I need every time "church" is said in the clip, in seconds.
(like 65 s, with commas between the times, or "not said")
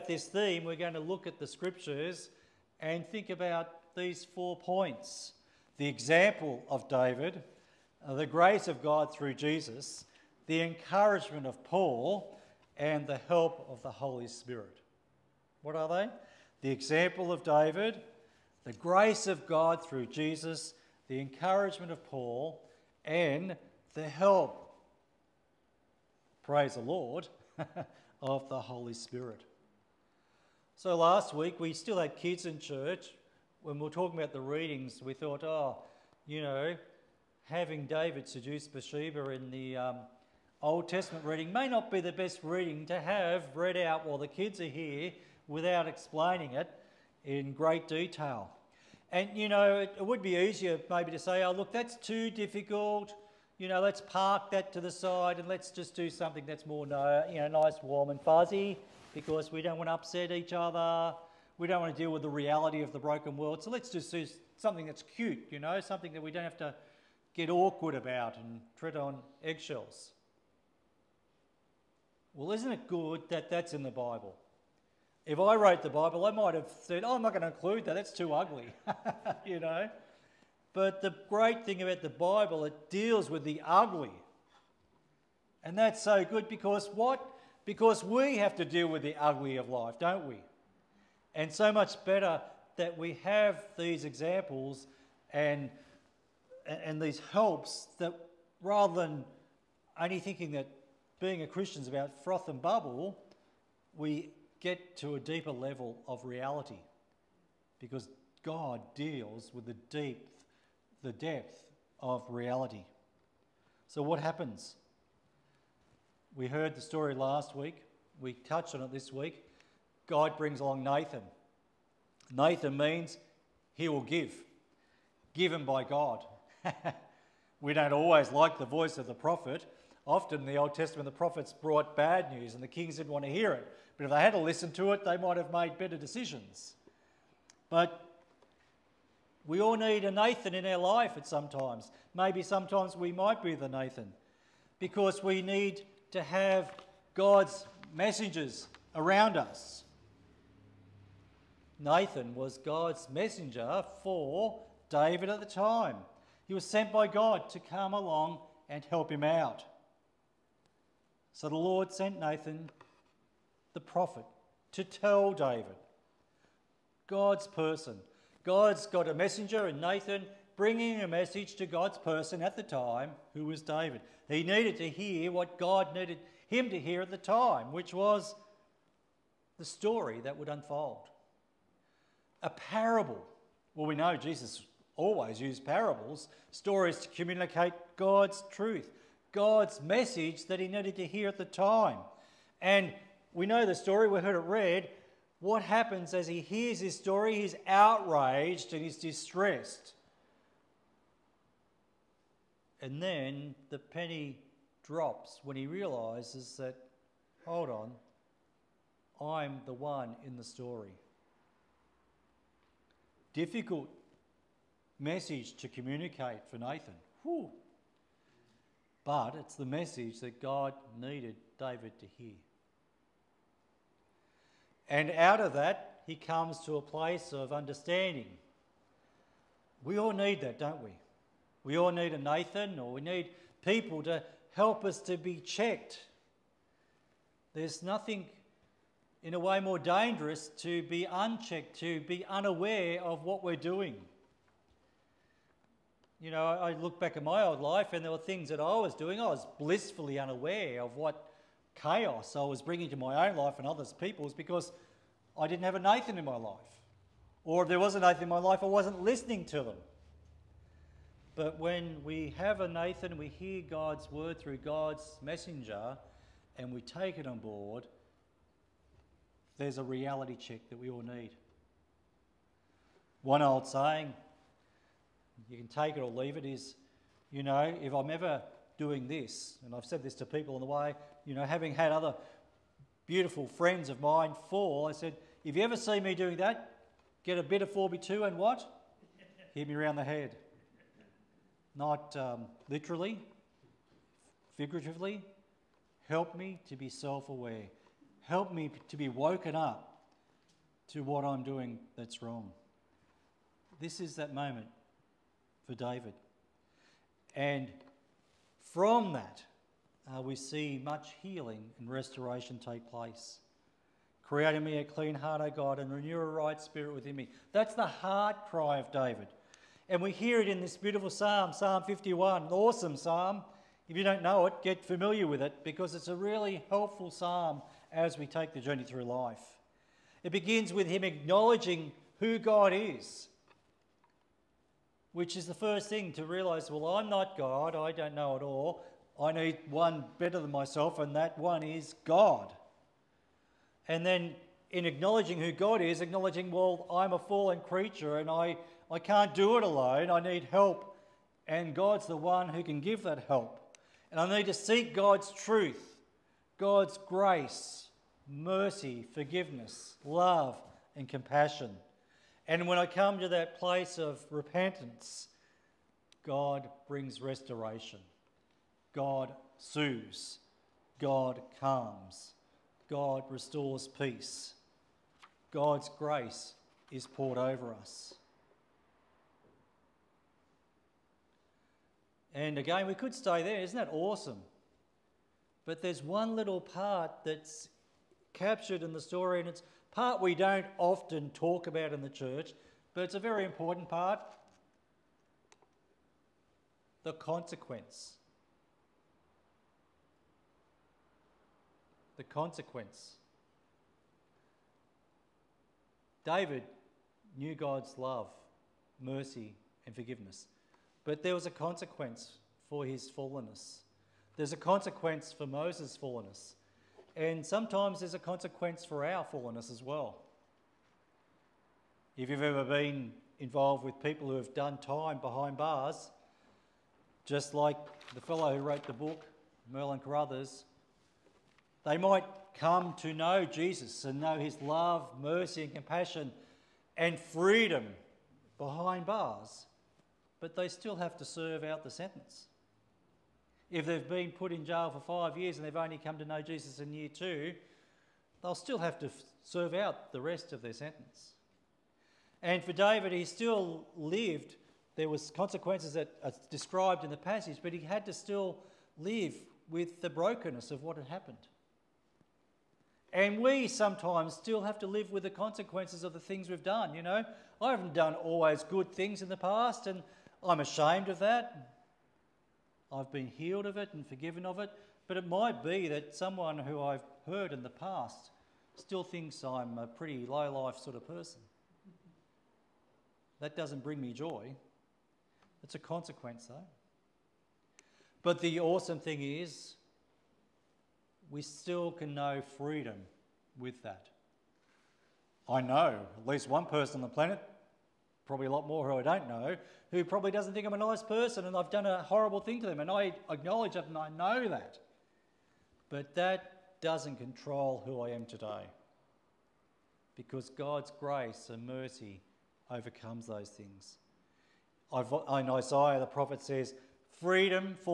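32 s, 392 s.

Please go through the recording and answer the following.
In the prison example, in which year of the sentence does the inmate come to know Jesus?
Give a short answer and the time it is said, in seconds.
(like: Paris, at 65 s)
Year 2, at 446 s.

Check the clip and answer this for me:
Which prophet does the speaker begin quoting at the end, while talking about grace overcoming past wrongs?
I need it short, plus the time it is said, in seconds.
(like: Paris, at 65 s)
Isaiah, at 515 s.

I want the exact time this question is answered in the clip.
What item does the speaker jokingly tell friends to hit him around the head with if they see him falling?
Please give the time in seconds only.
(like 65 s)
287 s.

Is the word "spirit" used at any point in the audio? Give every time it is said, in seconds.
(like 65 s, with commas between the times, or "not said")
14 s, 28 s, 316 s.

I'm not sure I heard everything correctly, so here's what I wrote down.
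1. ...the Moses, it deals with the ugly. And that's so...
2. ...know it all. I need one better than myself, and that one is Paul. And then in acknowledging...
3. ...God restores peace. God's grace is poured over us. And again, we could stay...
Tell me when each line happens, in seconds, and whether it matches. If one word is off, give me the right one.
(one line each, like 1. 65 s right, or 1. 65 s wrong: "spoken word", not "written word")
1. 82 s wrong: "Bible", not "Moses"
2. 338 s wrong: "God", not "Paul"
3. 372 s right.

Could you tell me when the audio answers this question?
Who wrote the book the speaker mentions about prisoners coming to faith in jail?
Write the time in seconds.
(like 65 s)
429 s.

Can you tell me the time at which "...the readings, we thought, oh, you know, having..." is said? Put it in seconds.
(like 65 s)
34 s.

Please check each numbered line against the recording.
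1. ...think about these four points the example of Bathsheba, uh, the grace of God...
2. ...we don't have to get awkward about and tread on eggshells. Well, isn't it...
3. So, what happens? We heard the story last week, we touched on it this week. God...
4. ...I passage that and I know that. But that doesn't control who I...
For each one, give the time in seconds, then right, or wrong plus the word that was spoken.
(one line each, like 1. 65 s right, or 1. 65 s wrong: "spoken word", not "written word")
1. 3 s wrong: "David", not "Bathsheba"
2. 66 s right
3. 113 s right
4. 502 s wrong: "acknowledge", not "passage".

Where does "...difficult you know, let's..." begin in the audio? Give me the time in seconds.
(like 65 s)
52 s.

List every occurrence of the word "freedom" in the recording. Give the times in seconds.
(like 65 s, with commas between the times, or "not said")
437 s, 492 s, 517 s.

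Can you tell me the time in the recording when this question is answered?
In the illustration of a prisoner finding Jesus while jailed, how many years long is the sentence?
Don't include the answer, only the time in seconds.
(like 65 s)
445 s.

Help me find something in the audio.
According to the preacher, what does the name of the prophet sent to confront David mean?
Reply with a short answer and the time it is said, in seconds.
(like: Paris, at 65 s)
He will give, at 123 s.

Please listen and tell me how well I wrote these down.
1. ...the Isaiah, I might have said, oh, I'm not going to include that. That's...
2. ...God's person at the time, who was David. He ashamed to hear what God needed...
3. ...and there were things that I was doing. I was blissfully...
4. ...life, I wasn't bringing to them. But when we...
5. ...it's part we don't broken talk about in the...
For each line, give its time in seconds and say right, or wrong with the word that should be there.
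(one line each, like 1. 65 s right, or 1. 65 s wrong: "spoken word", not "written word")
1. 75 s wrong: "Bible", not "Isaiah"
2. 171 s wrong: "needed", not "ashamed"
3. 247 s right
4. 258 s wrong: "listening", not "bringing"
5. 389 s wrong: "often", not "broken".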